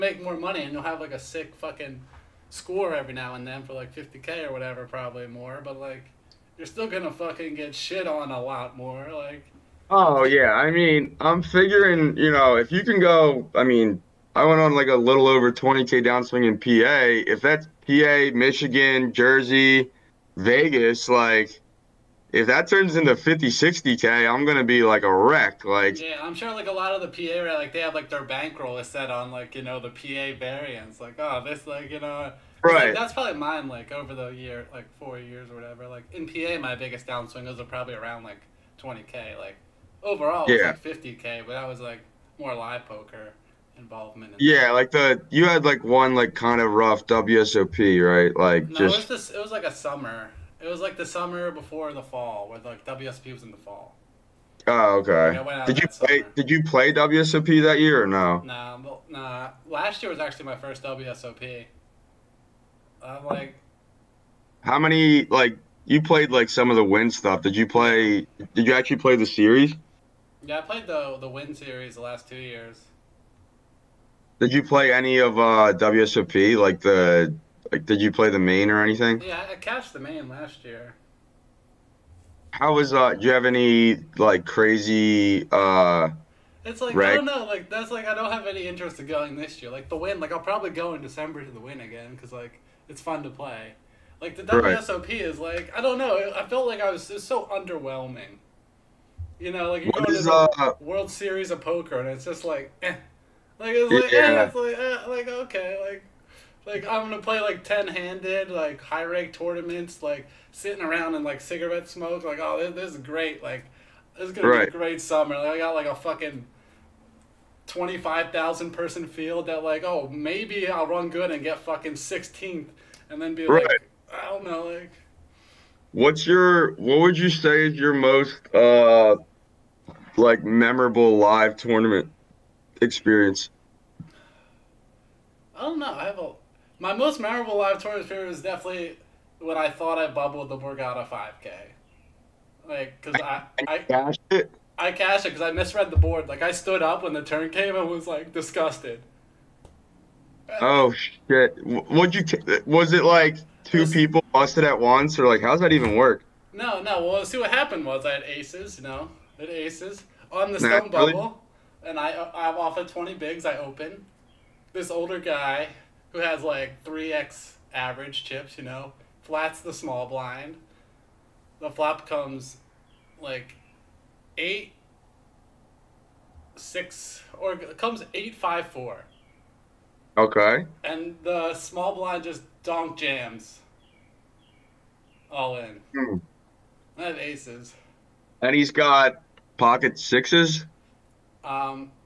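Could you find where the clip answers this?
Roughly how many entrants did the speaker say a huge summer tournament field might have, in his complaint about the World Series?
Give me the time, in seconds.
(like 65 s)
117 s.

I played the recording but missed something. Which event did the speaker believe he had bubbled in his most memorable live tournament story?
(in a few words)
the Borgata 5K.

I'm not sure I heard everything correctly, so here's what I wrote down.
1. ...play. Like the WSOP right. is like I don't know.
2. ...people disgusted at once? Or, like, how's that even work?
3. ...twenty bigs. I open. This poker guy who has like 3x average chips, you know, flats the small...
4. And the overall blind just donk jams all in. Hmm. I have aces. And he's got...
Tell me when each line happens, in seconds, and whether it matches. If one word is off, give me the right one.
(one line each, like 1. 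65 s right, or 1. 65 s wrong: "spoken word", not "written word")
1. 93 s right
2. 153 s wrong: "busted", not "disgusted"
3. 162 s wrong: "older", not "poker"
4. 180 s wrong: "small", not "overall".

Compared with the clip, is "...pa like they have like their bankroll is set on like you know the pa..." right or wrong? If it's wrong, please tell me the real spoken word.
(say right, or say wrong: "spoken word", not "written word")
right.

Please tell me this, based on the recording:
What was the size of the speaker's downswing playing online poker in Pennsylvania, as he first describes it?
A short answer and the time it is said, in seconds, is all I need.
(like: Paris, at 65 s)
a little over 20k, at 14 s.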